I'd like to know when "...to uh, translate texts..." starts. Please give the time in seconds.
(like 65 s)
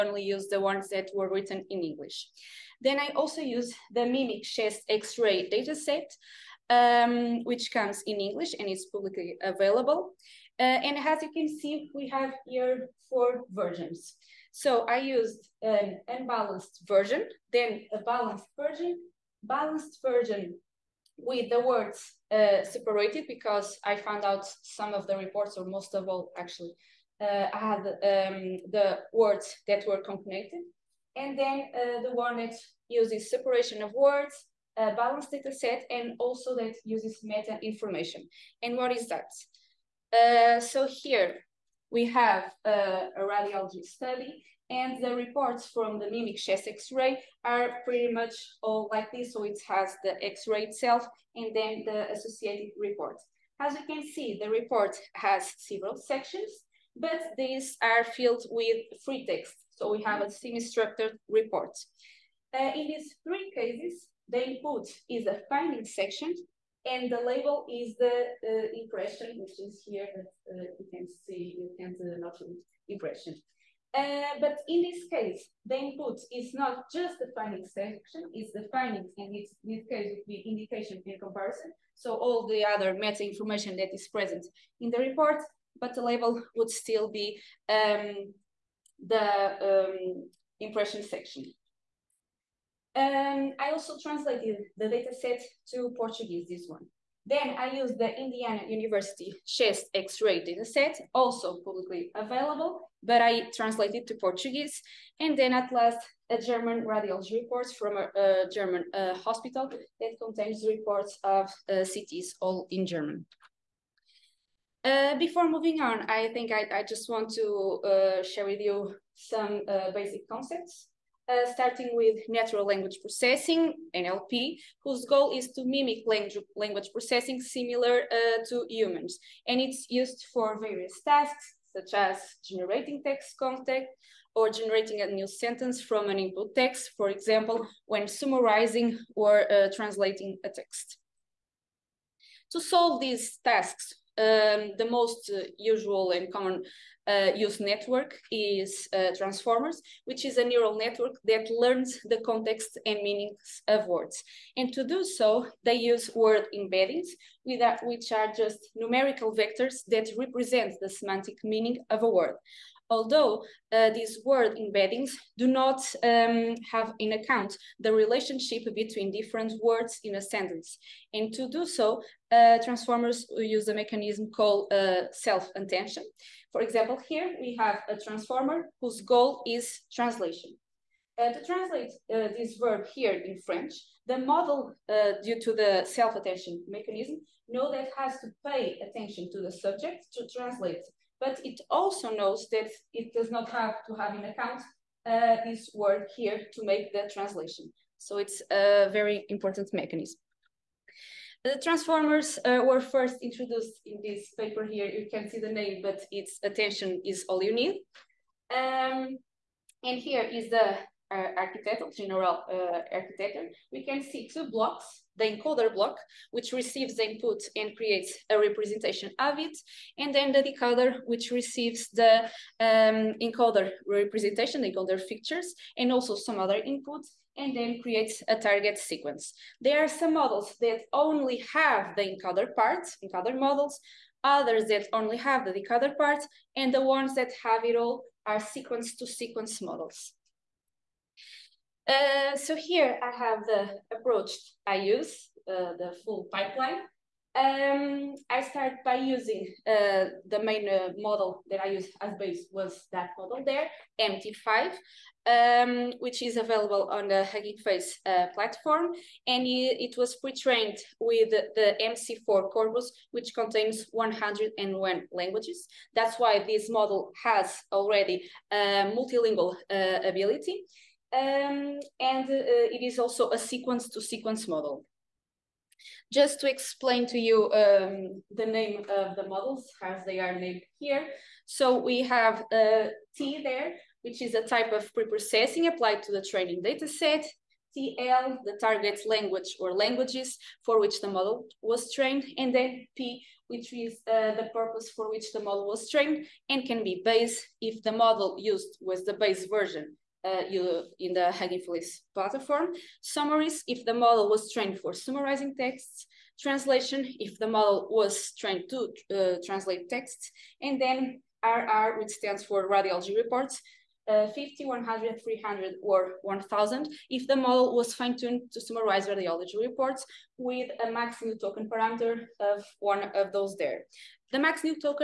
308 s.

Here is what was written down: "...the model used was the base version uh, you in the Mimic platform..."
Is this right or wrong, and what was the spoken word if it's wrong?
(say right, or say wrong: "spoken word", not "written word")
wrong: "Face", not "Mimic".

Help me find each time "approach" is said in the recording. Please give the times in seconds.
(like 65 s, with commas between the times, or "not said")
243 s.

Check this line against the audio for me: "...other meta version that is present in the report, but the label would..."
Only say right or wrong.
wrong.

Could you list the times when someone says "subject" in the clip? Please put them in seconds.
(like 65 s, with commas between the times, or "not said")
189 s.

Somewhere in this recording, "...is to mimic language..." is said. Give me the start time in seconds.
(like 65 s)
125 s.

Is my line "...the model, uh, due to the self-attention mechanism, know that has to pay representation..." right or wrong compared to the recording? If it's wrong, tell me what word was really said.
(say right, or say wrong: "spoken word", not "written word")
wrong: "attention", not "representation".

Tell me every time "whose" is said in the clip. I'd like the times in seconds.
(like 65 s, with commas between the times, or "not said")
124 s, 178 s.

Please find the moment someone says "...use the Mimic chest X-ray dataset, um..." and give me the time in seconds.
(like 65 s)
3 s.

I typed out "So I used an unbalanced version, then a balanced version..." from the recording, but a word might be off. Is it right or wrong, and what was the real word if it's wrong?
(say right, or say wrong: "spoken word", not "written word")
right.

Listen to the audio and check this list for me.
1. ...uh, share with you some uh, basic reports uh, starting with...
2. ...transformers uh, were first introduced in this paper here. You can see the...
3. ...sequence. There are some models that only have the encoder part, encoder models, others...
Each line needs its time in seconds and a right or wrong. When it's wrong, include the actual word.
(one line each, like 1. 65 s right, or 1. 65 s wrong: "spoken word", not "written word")
1. 117 s wrong: "concepts", not "reports"
2. 201 s right
3. 228 s right.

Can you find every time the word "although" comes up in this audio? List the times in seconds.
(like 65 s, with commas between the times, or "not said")
162 s.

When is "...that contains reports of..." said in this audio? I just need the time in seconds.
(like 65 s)
110 s.